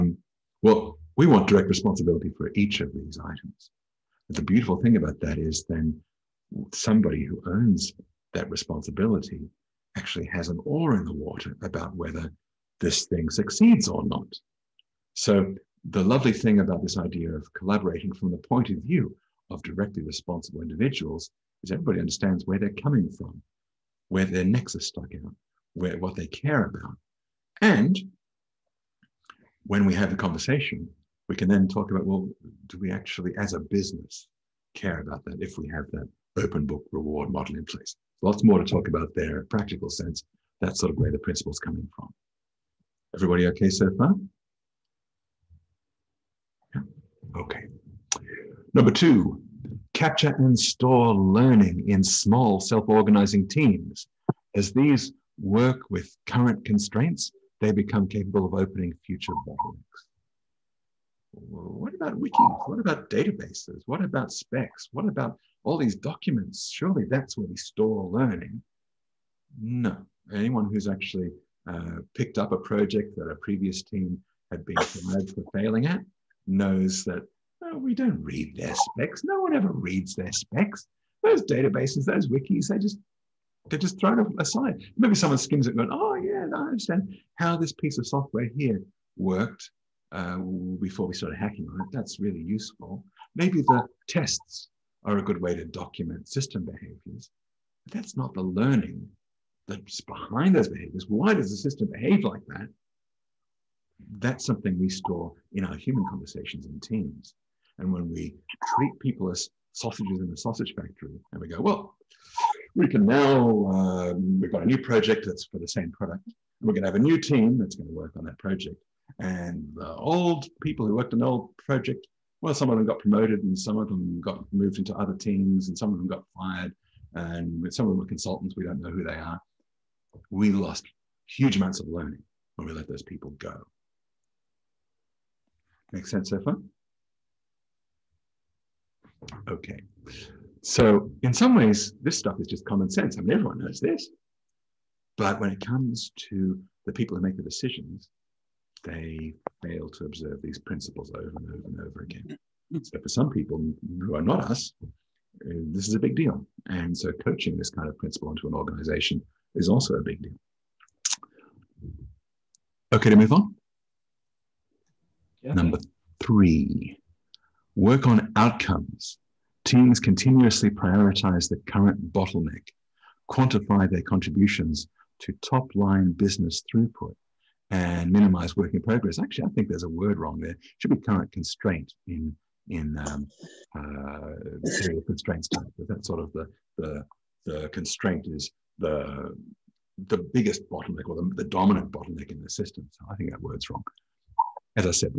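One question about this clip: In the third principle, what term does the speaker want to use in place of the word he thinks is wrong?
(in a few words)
current constraint.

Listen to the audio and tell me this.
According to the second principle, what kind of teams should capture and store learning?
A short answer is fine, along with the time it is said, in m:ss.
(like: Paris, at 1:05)
small self-organizing teams, at 0:52.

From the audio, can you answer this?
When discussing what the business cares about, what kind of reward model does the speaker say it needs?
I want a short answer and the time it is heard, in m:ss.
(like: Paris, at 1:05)
open book, at 0:36.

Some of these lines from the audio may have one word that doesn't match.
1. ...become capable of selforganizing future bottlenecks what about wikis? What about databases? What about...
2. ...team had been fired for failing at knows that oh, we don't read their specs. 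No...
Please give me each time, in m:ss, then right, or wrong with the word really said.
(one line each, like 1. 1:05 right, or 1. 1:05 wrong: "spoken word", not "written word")
1. 0:57 wrong: "opening", not "selforganizing"
2. 1:13 right.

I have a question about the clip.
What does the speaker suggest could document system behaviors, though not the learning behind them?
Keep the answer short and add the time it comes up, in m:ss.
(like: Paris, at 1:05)
the tests, at 1:33.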